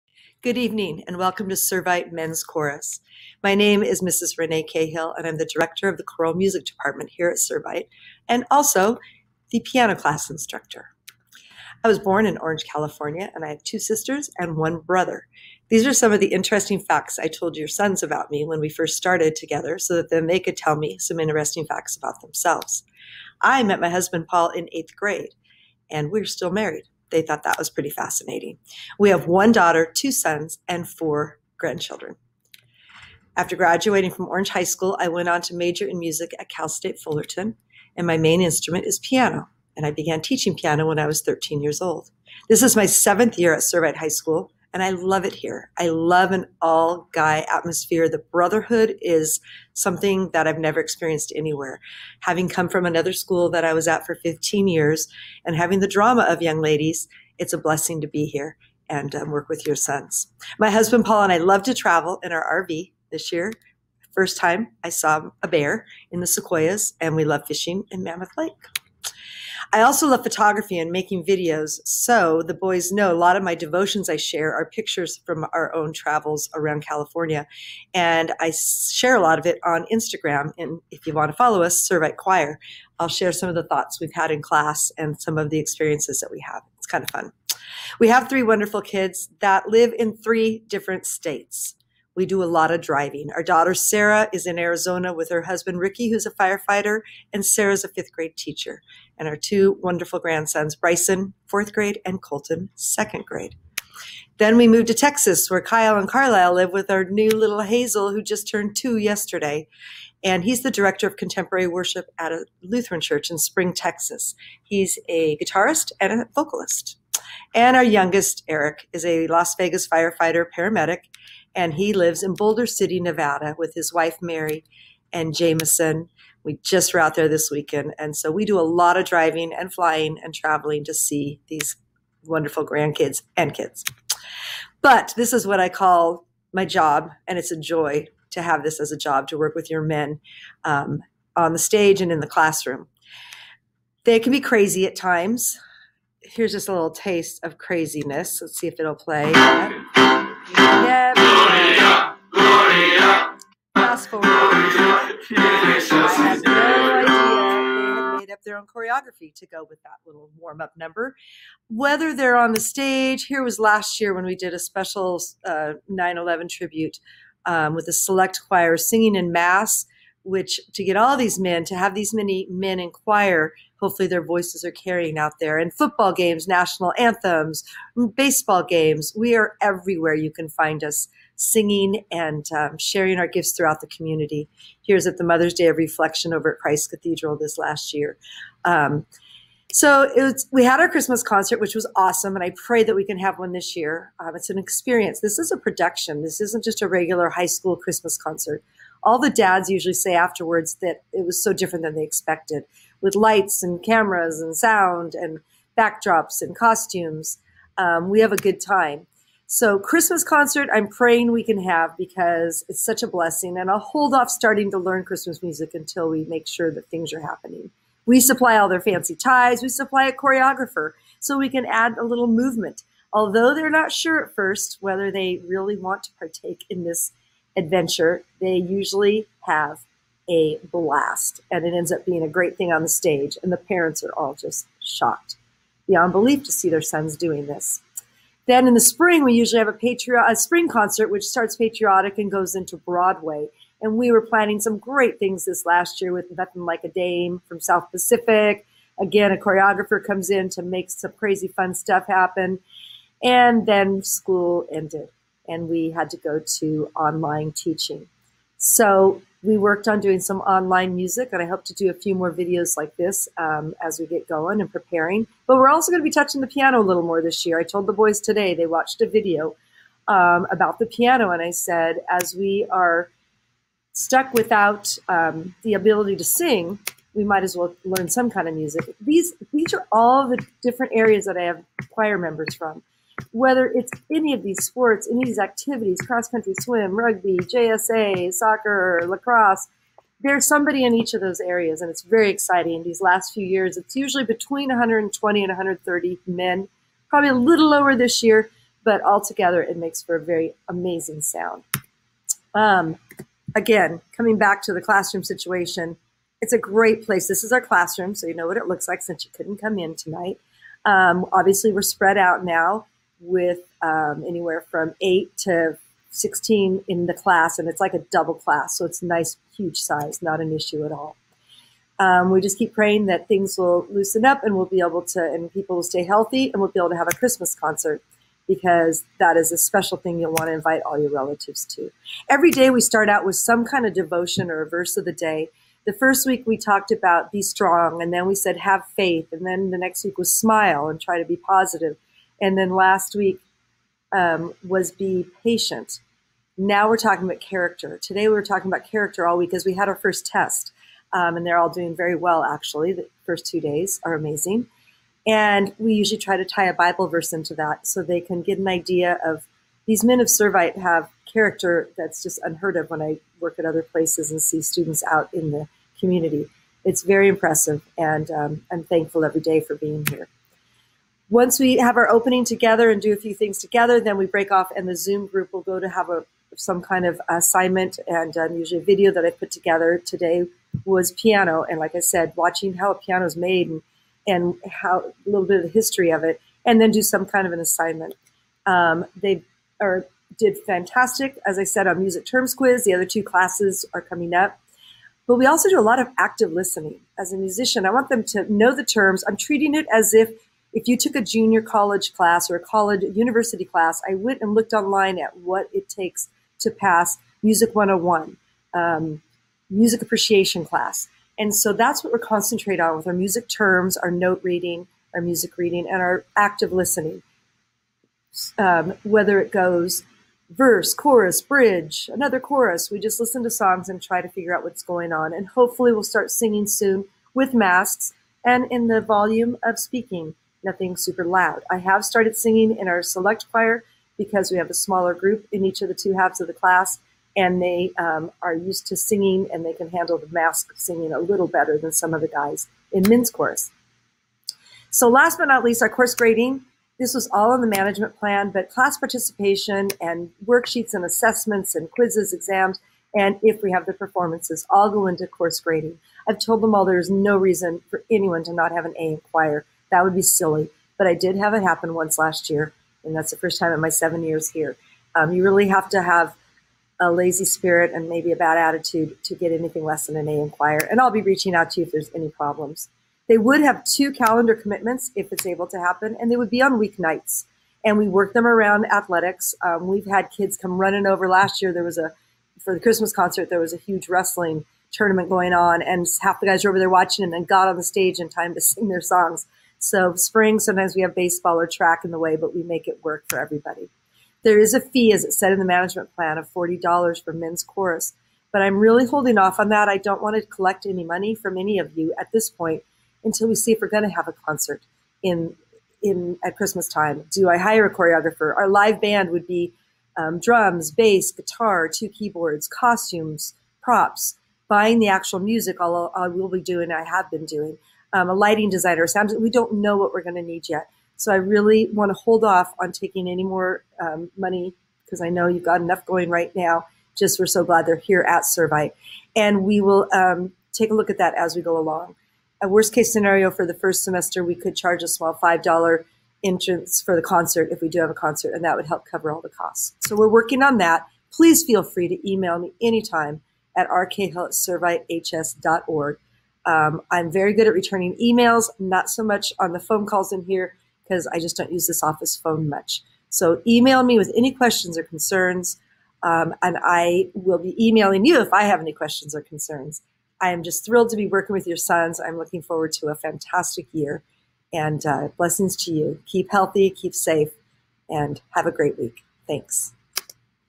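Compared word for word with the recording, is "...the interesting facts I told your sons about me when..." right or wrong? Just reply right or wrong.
right.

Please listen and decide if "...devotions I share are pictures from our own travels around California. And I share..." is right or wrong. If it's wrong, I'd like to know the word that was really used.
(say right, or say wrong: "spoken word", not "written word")
right.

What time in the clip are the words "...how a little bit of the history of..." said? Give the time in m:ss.
6:24.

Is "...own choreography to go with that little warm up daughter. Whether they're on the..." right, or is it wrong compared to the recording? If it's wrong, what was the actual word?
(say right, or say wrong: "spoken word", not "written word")
wrong: "number", not "daughter".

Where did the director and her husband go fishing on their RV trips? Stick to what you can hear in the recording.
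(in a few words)
Mammoth Lake.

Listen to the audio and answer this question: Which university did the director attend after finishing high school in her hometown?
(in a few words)
Cal State Fullerton.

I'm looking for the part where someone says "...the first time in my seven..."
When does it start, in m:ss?
7:43.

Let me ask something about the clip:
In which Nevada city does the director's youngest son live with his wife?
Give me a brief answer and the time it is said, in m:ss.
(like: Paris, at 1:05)
Boulder City, at 2:02.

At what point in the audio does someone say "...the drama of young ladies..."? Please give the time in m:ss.
0:55.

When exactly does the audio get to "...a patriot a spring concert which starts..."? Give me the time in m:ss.
3:59.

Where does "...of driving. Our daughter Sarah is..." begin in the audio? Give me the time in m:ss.
1:32.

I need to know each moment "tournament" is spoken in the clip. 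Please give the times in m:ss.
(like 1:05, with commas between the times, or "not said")
8:04.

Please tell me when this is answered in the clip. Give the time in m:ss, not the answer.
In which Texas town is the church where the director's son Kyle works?
1:53.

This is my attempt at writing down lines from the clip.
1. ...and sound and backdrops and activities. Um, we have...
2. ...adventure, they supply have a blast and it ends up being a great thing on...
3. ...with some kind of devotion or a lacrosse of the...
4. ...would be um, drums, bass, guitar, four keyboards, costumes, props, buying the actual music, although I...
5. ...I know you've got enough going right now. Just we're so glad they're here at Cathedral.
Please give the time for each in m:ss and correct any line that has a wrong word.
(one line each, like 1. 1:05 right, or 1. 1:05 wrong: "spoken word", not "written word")
1. 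3:24 wrong: "costumes", not "activities"
2. 3:47 wrong: "usually", not "supply"
3. 5:33 wrong: "verse", not "lacrosse"
4. 8:29 wrong: "two", not "four"
5. 8:45 wrong: "Servite", not "Cathedral".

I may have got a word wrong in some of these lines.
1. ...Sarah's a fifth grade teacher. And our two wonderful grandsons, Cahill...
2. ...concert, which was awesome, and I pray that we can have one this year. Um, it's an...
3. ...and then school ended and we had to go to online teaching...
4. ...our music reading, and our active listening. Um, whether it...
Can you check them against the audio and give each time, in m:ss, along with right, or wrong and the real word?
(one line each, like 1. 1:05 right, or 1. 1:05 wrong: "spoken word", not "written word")
1. 1:37 wrong: "Bryson", not "Cahill"
2. 3:11 right
3. 4:13 right
4. 6:55 right.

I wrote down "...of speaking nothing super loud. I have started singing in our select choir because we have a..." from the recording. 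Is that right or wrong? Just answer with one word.
right.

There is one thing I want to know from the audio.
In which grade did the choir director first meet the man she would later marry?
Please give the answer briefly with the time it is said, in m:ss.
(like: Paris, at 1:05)
Eighth grade, at 0:24.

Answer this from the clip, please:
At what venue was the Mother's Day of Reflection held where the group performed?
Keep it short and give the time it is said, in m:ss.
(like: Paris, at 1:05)
Christ Cathedral, at 3:06.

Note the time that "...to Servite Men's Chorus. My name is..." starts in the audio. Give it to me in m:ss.
0:01.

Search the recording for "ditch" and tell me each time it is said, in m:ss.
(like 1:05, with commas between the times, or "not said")
not said.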